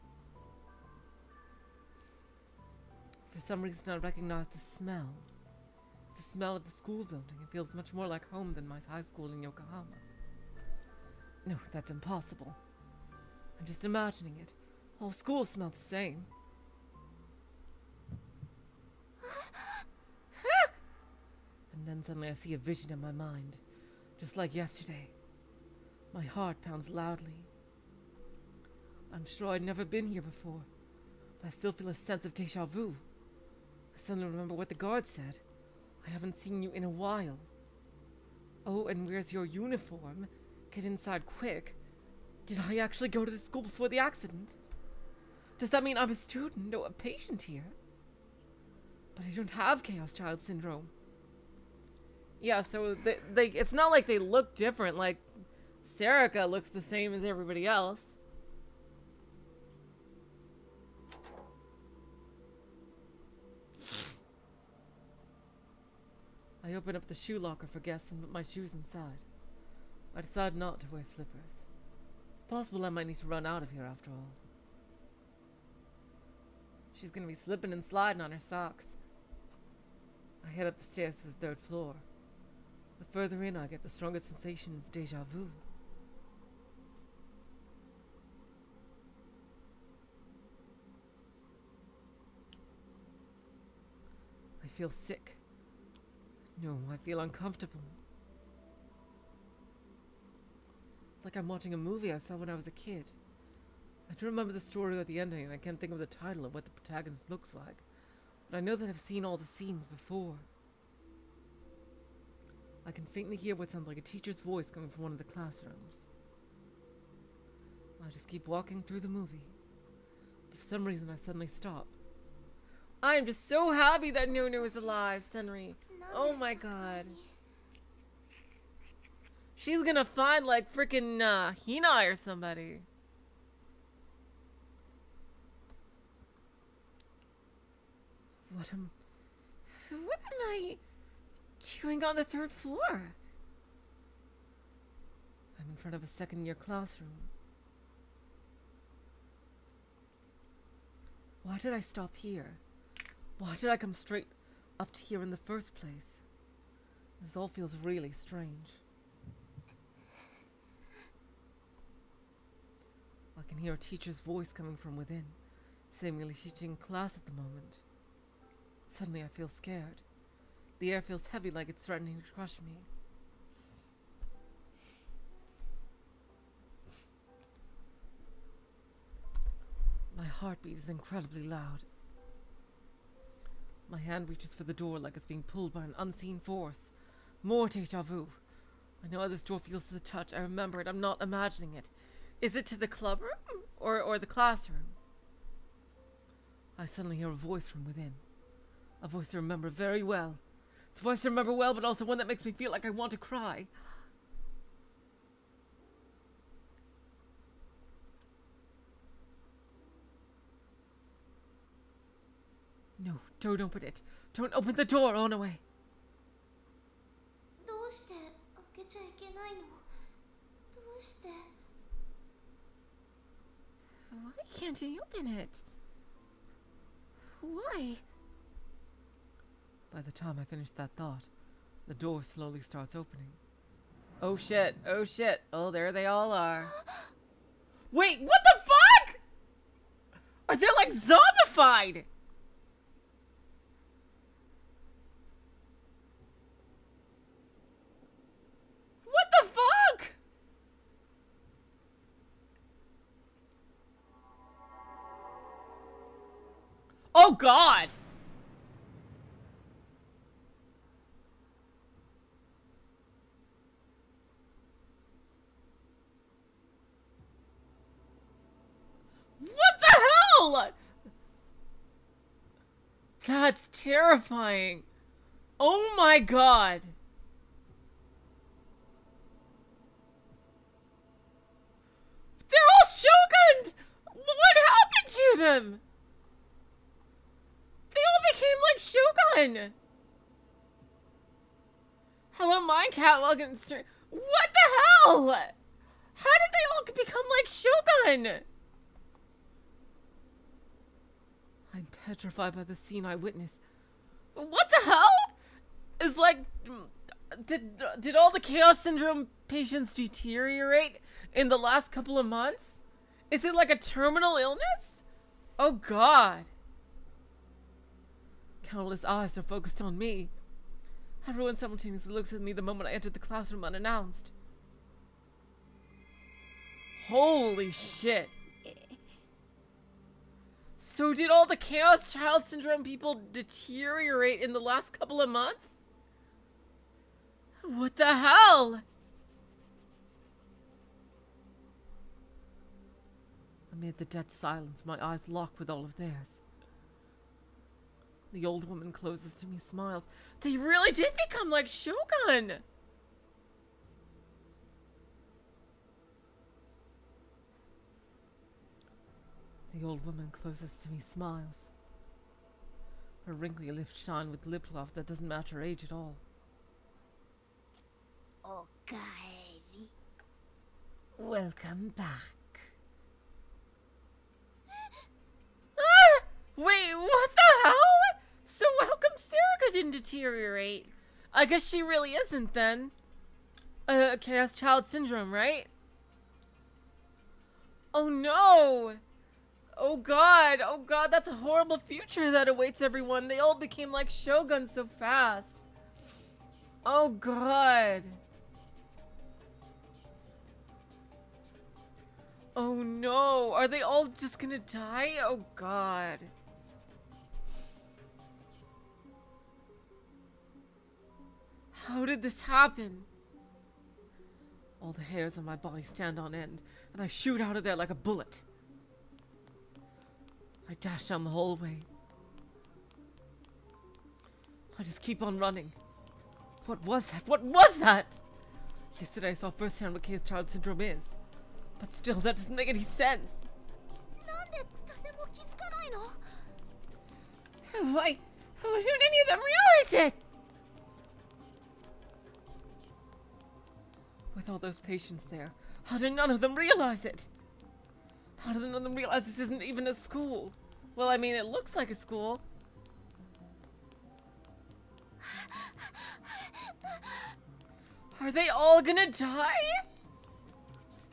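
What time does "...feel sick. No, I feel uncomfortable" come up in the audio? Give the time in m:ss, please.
1:34.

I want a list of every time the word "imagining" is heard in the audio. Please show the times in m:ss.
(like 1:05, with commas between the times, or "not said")
0:13, 3:11.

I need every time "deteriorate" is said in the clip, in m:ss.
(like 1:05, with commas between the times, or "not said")
5:09, 5:33, 6:19.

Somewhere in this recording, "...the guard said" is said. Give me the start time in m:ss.
0:34.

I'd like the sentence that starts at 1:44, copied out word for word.
I do remember the story or the ending, and I can't think of the title of what the protagonist looks like.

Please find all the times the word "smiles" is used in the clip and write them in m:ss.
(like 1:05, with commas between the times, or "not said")
5:49, 6:01.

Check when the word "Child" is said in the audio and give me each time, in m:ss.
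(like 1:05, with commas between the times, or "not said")
0:50, 5:32, 6:24, 7:10.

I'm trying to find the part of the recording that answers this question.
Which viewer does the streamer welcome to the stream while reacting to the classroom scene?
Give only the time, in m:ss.
4:52.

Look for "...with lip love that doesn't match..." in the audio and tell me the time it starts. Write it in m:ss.
6:04.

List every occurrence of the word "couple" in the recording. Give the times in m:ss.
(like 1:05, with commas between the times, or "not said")
5:11, 5:34.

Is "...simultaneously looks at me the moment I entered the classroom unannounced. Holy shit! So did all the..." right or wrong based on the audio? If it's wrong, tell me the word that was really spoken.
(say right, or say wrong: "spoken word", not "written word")
right.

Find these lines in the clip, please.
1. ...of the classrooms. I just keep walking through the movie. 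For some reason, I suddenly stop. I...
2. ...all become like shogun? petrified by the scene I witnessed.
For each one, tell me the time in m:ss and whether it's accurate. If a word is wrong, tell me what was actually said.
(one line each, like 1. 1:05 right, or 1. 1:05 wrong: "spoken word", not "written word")
1. 1:55 right
2. 4:56 right.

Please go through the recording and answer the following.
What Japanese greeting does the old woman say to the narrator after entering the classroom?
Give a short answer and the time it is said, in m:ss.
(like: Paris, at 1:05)
Okaeri, at 6:08.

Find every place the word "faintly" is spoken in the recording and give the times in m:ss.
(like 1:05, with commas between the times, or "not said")
1:53.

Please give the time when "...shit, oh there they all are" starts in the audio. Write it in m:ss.
3:55.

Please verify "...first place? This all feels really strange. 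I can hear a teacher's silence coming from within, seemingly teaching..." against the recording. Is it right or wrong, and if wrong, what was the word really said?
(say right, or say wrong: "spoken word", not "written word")
wrong: "voice", not "silence".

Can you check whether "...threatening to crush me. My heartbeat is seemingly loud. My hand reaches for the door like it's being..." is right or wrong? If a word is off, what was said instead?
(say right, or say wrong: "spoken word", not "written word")
wrong: "incredibly", not "seemingly".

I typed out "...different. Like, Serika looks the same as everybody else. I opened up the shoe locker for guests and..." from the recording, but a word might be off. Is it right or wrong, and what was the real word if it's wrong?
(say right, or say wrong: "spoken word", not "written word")
right.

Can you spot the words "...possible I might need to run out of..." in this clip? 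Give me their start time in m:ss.
1:12.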